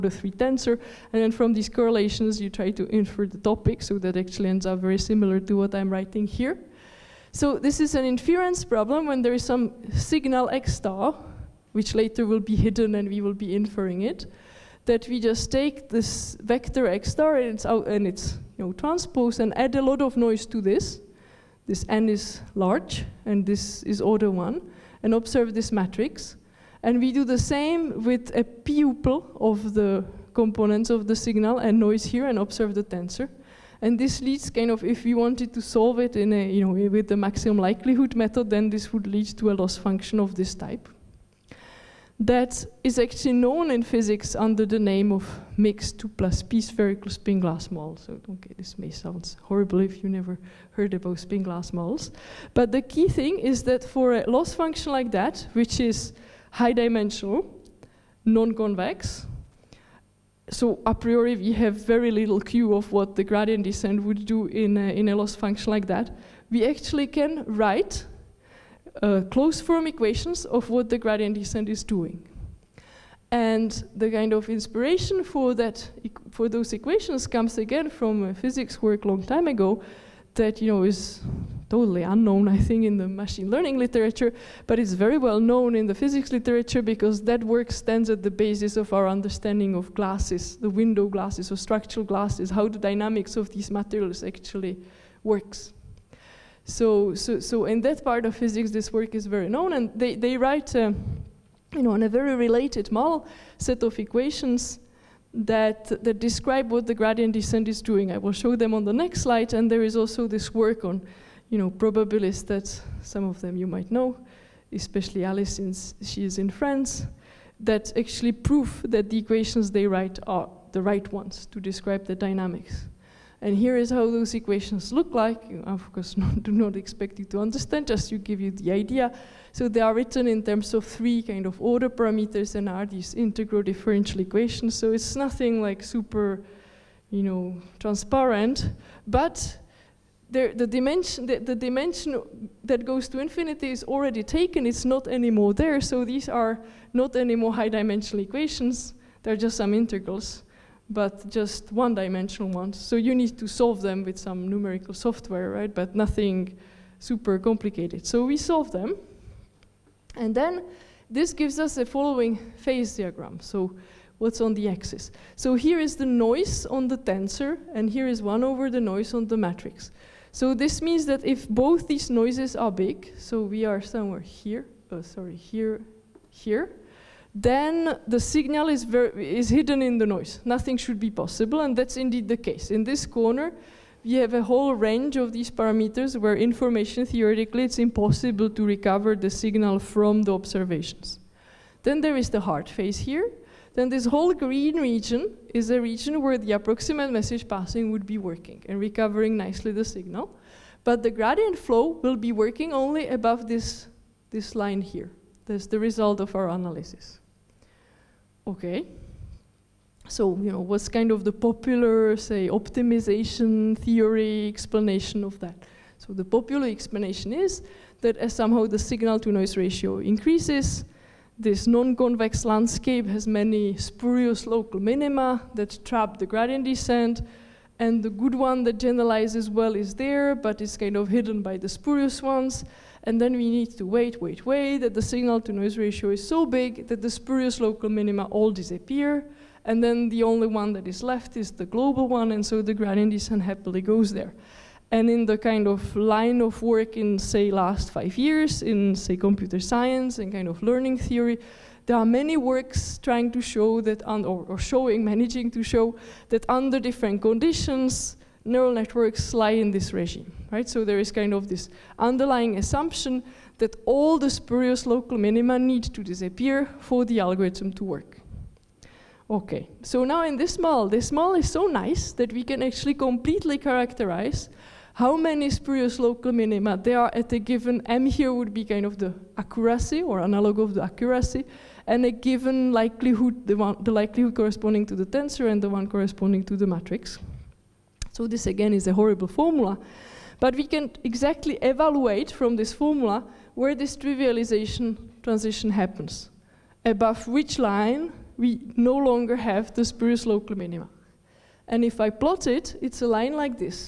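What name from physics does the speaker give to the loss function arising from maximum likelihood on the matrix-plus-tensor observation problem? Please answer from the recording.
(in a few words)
mixed 2 plus p spherical spin glass model.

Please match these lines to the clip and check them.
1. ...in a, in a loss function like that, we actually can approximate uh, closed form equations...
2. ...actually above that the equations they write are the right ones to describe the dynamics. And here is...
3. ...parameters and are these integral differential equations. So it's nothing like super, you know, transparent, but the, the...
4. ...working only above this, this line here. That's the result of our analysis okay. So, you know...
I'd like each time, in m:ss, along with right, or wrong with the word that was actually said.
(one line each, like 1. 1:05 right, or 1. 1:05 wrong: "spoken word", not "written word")
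1. 1:04 wrong: "write", not "approximate"
2. 1:57 wrong: "prove", not "above"
3. 2:11 right
4. 3:22 right.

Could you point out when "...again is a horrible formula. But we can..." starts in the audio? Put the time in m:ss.
4:48.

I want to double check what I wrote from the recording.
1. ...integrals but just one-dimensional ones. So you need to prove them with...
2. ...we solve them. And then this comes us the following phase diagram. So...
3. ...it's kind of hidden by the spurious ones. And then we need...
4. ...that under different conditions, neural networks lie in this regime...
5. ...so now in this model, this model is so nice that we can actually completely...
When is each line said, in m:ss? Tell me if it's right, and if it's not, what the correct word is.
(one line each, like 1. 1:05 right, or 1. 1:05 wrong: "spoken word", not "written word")
1. 2:29 wrong: "solve", not "prove"
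2. 2:38 wrong: "gives", not "comes"
3. 3:50 right
4. 4:16 right
5. 4:29 right.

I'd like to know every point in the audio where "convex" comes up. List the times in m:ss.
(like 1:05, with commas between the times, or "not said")
0:58, 3:41.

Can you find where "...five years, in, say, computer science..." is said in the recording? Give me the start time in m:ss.
4:07.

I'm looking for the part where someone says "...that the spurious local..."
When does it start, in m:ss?
3:56.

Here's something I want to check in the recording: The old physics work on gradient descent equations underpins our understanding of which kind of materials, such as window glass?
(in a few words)
structural glasses.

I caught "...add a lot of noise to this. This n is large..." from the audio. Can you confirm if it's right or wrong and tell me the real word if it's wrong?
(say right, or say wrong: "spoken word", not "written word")
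right.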